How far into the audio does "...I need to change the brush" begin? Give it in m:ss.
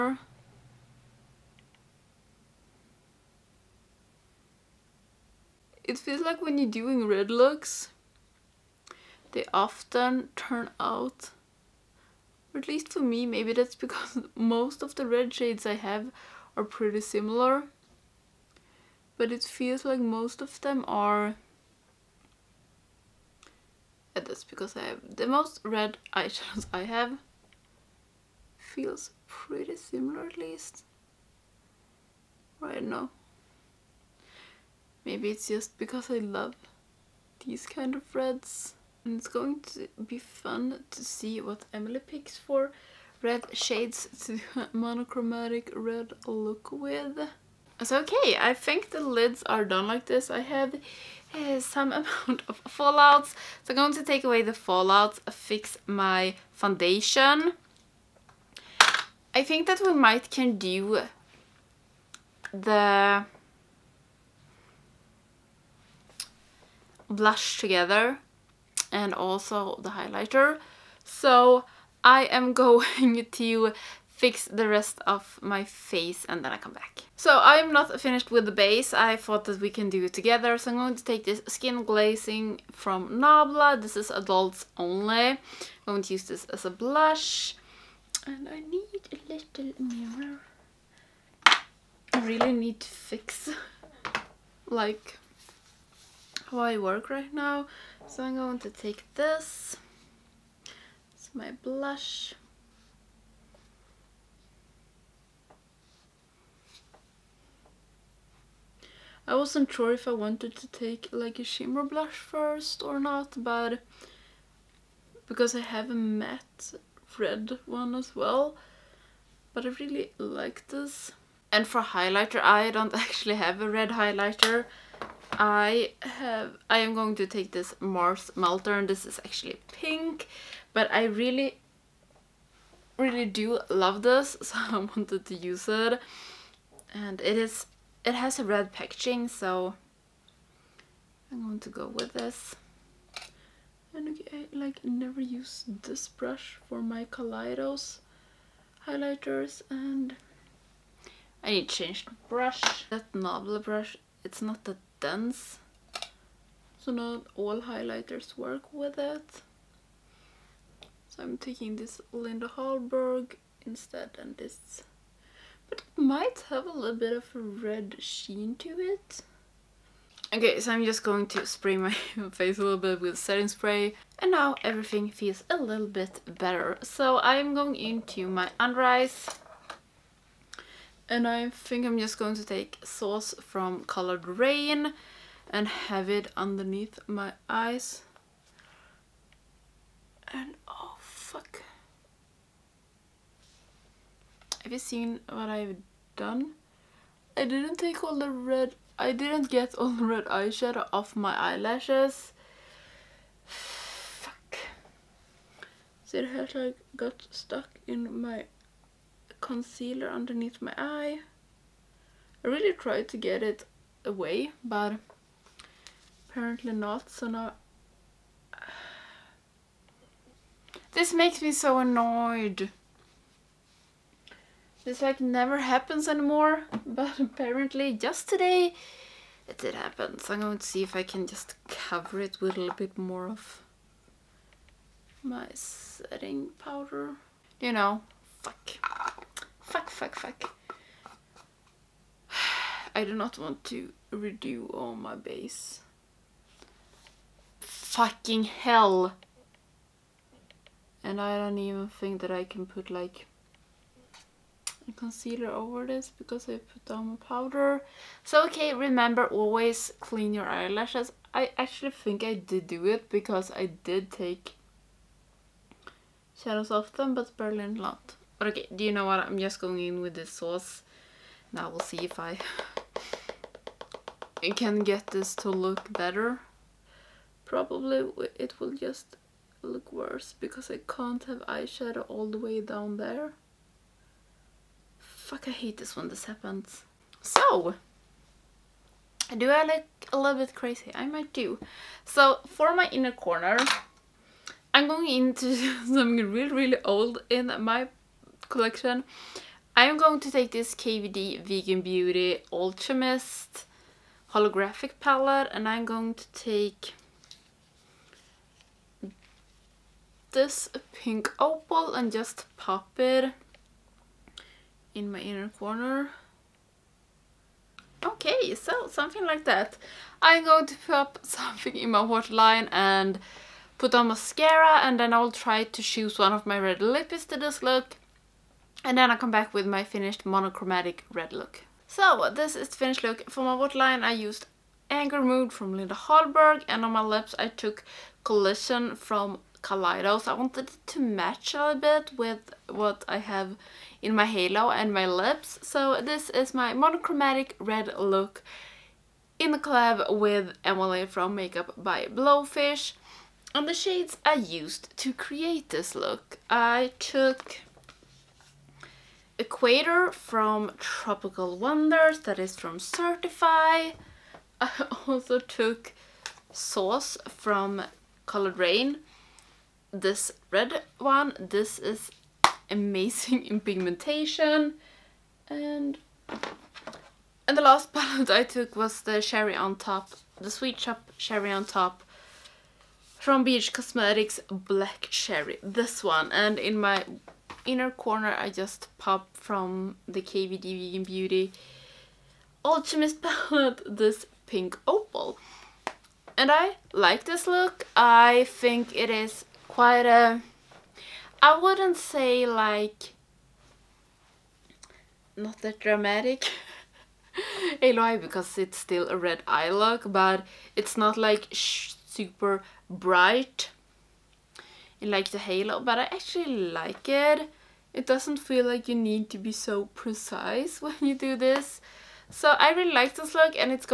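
2:31.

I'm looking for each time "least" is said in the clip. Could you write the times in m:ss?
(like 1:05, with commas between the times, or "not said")
0:12, 0:30.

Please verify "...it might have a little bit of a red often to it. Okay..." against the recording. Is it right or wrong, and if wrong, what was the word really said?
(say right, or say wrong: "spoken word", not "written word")
wrong: "sheen", not "often".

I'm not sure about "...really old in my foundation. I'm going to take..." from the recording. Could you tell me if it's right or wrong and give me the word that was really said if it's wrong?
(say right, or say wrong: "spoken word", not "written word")
wrong: "collection", not "foundation".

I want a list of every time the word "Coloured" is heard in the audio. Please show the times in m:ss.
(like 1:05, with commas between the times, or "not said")
3:03, 6:08.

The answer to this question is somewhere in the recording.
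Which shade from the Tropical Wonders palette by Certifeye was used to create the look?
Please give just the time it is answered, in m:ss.
5:59.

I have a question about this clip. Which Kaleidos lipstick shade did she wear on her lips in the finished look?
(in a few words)
Collision.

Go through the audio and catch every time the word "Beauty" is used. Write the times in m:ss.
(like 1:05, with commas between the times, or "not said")
5:01, 6:31.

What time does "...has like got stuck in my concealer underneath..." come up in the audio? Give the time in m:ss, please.
3:26.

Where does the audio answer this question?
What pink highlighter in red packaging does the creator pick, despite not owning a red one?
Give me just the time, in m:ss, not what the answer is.
2:07.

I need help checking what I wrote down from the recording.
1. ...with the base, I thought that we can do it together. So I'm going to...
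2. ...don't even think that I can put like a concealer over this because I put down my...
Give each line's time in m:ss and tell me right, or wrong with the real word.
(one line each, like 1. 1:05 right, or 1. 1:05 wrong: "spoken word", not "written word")
1. 1:18 right
2. 4:11 right.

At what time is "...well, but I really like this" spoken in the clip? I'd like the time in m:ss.
1:58.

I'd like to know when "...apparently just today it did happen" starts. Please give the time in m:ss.
3:47.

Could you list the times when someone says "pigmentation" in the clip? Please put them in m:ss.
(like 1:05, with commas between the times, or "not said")
6:13.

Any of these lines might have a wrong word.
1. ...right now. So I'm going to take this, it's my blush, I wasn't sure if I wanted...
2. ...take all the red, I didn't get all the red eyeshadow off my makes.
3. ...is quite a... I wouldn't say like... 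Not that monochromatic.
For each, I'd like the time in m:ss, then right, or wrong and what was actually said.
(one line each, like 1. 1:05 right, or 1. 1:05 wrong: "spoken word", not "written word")
1. 1:37 right
2. 3:17 wrong: "eyelashes", not "makes"
3. 6:39 wrong: "dramatic", not "monochromatic".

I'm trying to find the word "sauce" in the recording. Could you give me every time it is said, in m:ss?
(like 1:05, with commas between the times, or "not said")
3:02, 4:30, 6:06.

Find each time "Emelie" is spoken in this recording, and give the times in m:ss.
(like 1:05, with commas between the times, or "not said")
0:41, 5:50.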